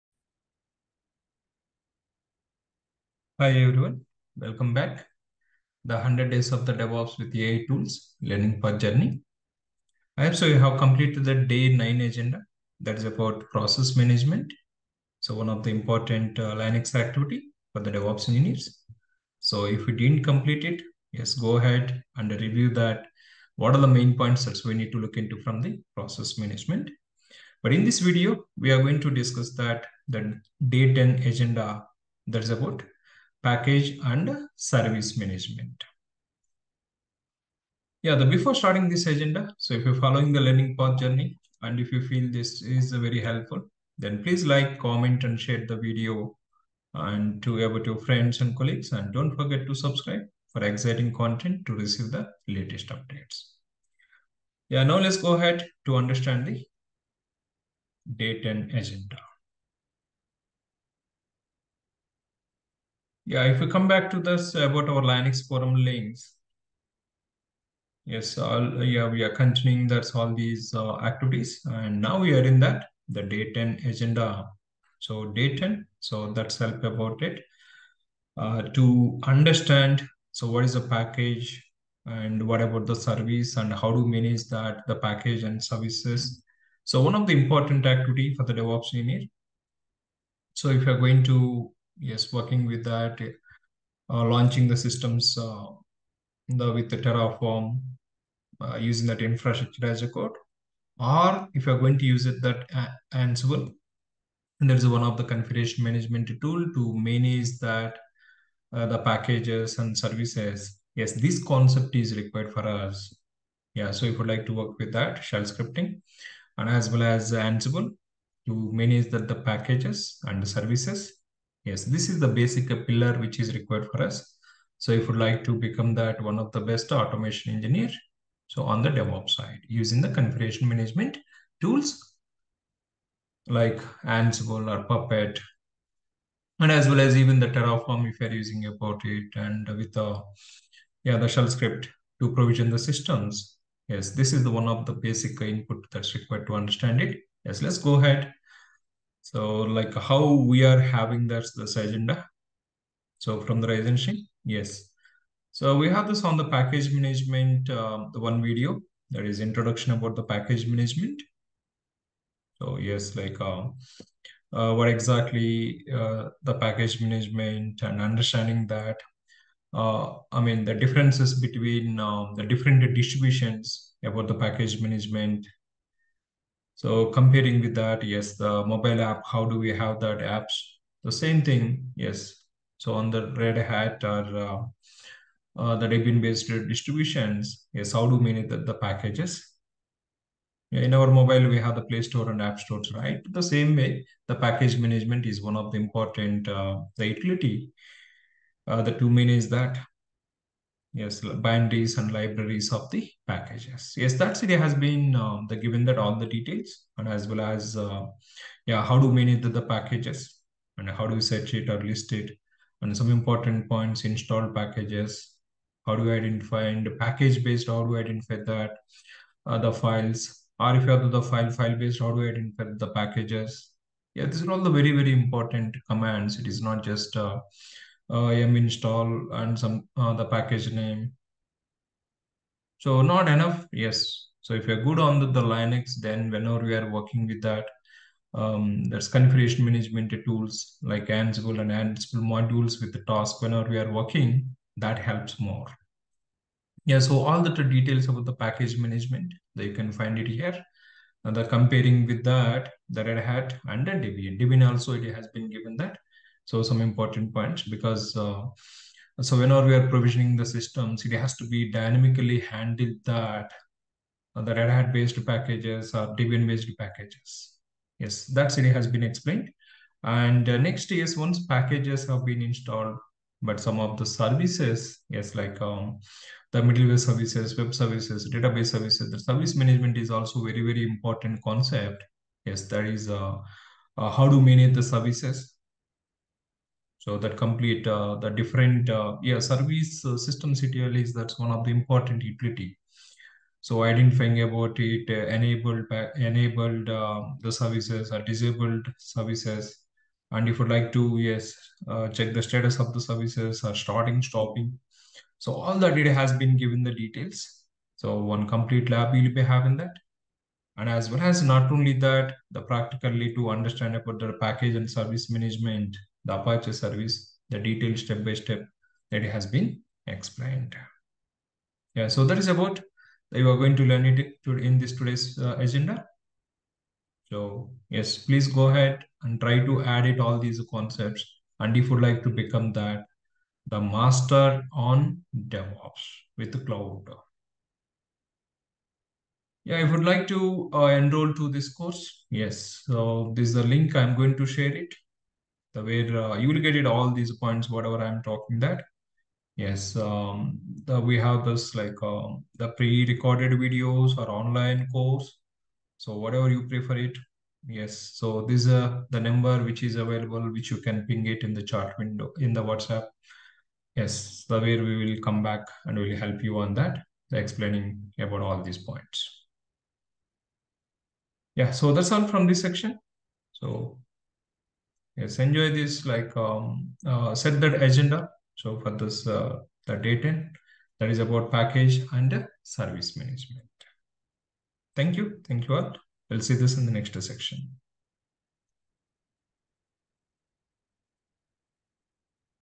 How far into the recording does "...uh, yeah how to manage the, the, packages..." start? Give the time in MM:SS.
03:27.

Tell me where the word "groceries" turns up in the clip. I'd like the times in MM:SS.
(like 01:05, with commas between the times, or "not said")
not said.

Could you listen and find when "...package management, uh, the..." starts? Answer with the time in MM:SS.
02:36.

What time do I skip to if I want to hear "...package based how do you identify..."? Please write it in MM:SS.
03:36.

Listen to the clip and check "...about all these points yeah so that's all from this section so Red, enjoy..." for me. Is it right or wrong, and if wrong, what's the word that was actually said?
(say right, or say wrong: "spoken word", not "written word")
wrong: "Yes", not "Red".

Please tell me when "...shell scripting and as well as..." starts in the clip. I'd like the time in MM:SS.
01:55.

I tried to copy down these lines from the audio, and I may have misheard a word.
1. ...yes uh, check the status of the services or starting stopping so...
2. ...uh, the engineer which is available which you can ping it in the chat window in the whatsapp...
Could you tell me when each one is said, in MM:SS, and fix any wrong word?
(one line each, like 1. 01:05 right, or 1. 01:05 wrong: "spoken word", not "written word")
1. 05:01 right
2. 05:58 wrong: "number", not "engineer".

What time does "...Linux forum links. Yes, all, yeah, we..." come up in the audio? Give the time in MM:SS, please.
01:05.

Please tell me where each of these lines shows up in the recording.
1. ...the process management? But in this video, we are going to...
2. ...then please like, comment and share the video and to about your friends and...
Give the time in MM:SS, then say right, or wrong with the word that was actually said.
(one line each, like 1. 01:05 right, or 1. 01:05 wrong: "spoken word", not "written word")
1. 00:25 right
2. 00:43 right.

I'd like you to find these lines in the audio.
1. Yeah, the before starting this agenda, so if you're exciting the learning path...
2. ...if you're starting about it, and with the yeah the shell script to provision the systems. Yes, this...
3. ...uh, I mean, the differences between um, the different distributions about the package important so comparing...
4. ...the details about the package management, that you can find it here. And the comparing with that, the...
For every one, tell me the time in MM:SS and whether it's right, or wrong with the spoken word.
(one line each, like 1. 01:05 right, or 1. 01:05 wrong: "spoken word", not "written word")
1. 00:38 wrong: "following", not "exciting"
2. 02:18 wrong: "using", not "starting"
3. 02:49 wrong: "management", not "important"
4. 04:07 right.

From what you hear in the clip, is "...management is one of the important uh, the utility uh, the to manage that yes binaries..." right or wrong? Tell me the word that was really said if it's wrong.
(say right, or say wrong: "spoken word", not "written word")
right.